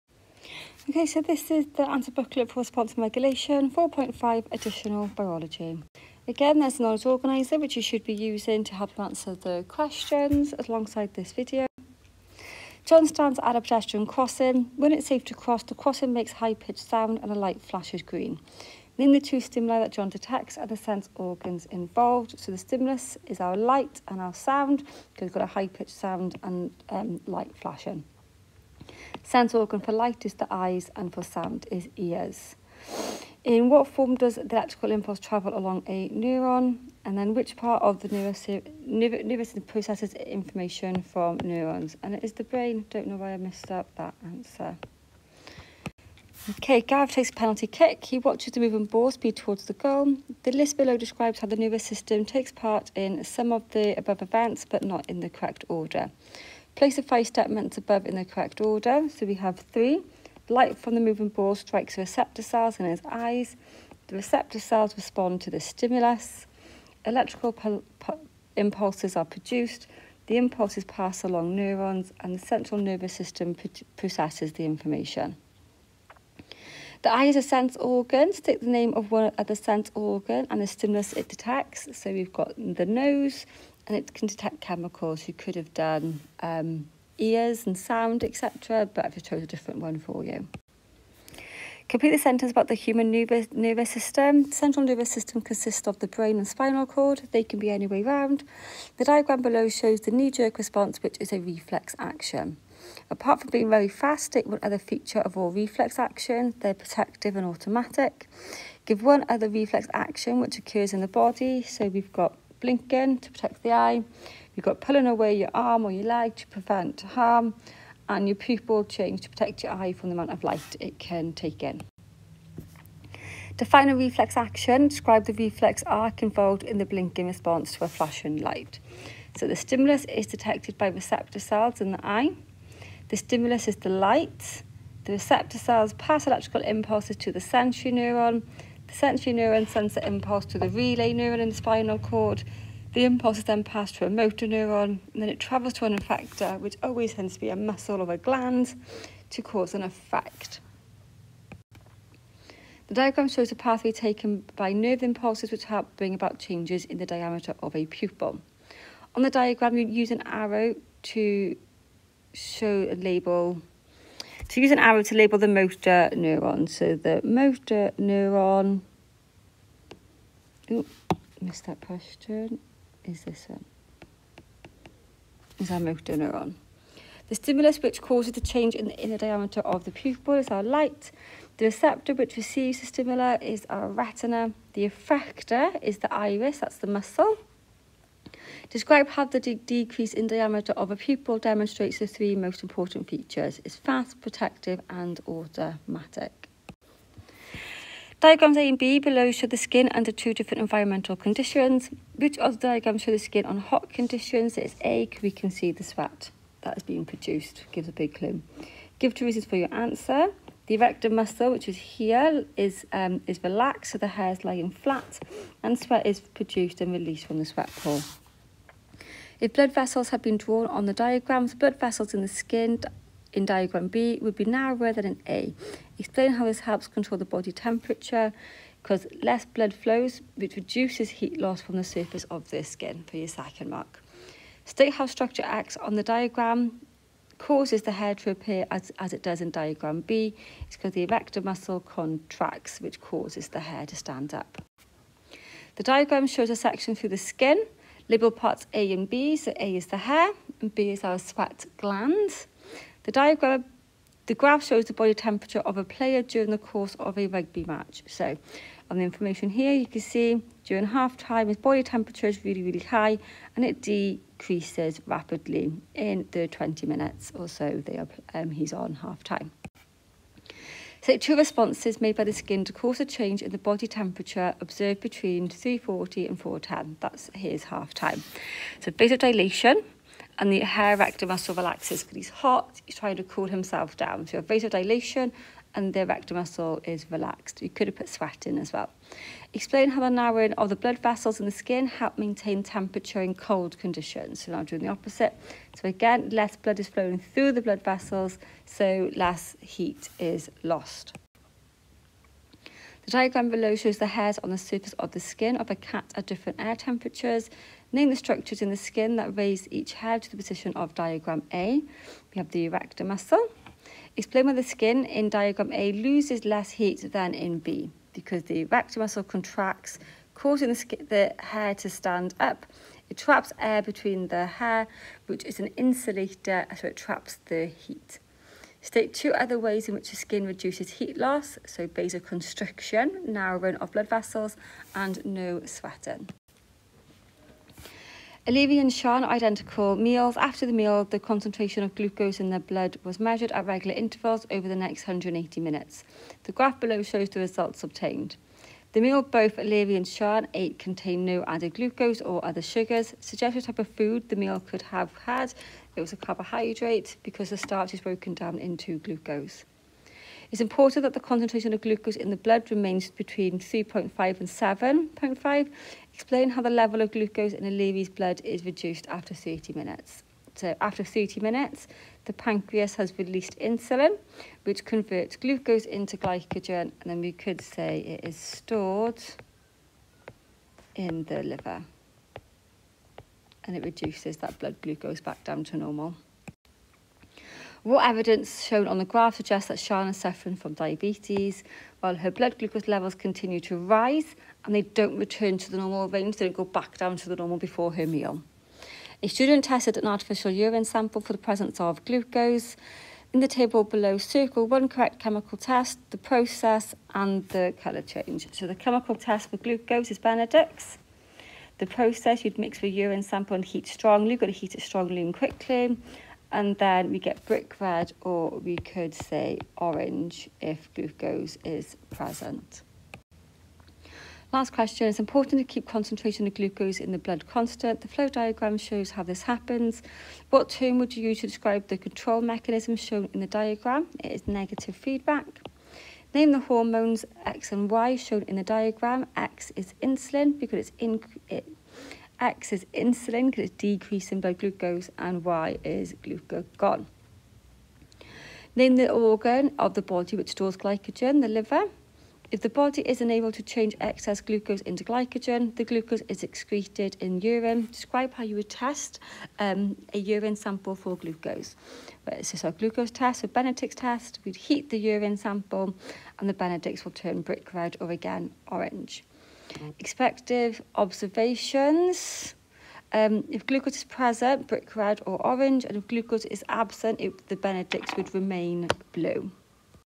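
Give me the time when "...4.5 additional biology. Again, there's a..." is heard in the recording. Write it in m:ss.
0:03.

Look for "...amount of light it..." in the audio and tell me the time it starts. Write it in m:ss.
2:00.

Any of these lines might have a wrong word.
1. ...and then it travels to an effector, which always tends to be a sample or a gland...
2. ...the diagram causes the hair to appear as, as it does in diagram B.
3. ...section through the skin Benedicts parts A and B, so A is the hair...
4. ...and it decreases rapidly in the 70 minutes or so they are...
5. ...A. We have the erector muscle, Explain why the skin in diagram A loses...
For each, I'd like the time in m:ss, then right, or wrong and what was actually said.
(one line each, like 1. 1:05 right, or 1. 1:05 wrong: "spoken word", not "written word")
1. 2:25 wrong: "muscle", not "sample"
2. 3:55 right
3. 4:06 wrong: "Liberal", not "Benedicts"
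4. 4:23 wrong: "20", not "70"
5. 5:11 right.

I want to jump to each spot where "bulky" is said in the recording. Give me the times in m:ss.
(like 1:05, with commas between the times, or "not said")
not said.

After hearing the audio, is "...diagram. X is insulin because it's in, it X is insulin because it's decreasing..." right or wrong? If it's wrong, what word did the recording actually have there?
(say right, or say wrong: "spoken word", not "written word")
right.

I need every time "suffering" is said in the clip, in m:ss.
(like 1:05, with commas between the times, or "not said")
6:30.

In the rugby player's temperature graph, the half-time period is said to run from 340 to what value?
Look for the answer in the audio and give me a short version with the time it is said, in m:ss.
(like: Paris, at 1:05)
410, at 4:36.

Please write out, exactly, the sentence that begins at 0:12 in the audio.
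John stands at a pedestrian crossing.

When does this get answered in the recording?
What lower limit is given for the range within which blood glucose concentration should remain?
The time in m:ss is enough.
6:03.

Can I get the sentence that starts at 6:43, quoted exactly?
In the table below, circle one correct chemical test, the process, and the colour change.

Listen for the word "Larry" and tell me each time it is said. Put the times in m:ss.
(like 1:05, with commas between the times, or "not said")
not said.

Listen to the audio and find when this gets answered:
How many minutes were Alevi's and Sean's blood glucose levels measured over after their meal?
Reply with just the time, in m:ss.
5:45.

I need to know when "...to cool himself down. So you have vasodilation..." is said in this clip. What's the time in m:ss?
4:43.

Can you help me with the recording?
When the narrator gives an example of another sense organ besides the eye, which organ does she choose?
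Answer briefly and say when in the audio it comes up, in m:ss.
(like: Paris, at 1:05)
Nose, at 1:22.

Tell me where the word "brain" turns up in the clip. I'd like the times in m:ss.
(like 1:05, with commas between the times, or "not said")
0:42, 1:36.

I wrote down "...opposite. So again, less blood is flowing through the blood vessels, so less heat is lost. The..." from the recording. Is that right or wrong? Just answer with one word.
right.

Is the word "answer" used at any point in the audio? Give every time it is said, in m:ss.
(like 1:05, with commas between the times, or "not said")
0:09, 0:44, 3:29.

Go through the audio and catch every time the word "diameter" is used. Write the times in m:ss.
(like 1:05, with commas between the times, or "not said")
2:37, 2:59, 3:10.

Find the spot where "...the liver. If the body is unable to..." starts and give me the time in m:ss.
7:31.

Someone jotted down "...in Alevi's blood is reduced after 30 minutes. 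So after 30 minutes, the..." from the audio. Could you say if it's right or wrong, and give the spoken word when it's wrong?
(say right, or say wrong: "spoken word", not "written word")
right.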